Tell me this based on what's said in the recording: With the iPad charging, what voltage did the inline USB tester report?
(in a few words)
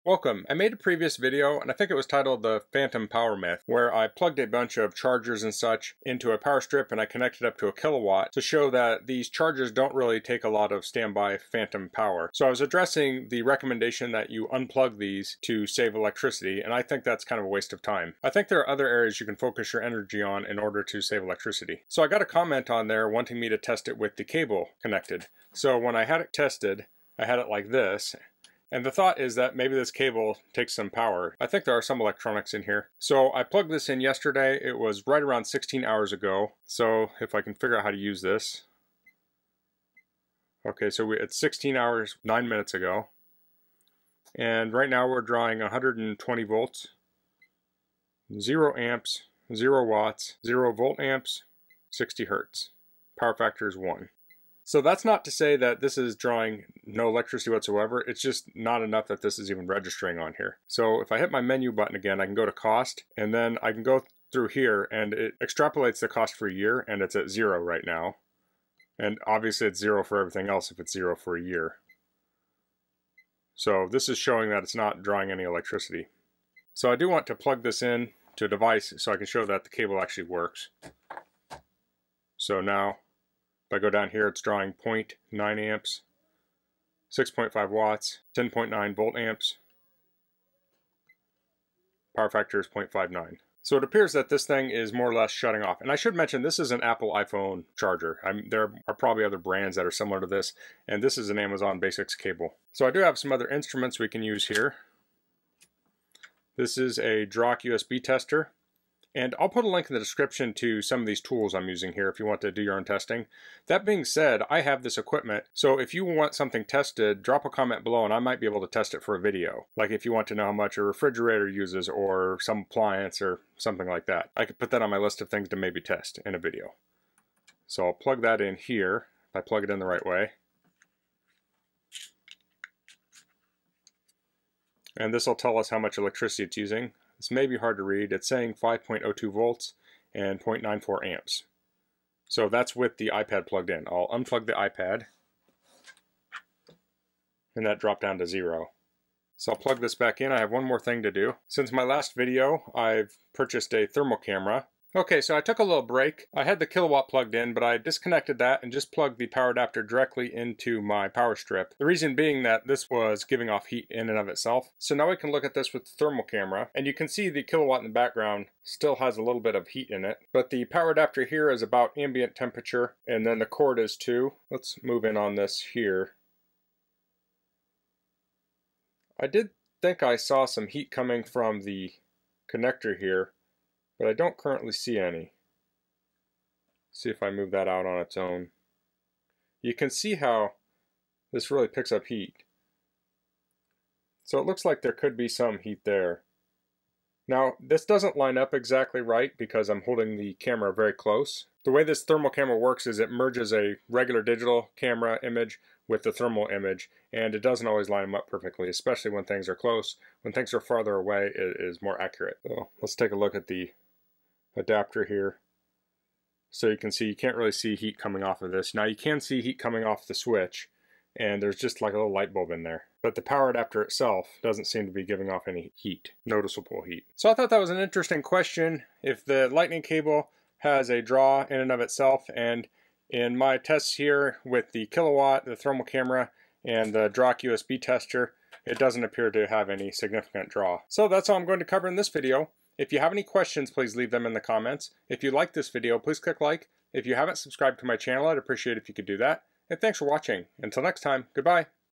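5.02 volts.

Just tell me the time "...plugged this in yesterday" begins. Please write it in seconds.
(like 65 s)
33 s.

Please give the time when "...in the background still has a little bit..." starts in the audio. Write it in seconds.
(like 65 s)
167 s.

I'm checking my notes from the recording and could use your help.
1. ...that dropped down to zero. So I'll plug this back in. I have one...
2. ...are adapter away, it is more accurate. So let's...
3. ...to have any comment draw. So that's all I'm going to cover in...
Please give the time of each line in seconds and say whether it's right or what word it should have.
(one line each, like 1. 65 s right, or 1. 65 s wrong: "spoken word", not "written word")
1. 147 s right
2. 210 s wrong: "farther", not "adapter"
3. 239 s wrong: "significant", not "comment".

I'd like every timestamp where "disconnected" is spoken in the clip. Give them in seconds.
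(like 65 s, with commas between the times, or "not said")
157 s.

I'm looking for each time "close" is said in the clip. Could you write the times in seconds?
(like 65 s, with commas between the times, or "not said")
200 s, 209 s.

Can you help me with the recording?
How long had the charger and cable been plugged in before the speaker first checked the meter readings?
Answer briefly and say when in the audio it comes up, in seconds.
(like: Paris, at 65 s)
16 hours, 9 minutes, at 41 s.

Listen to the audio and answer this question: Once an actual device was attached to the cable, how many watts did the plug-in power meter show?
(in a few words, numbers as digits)
6.5 watts.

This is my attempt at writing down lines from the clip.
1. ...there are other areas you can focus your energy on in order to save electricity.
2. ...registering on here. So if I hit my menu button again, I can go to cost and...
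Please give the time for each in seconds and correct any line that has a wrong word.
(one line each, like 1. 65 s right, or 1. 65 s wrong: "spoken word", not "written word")
1. 18 s right
2. 59 s right.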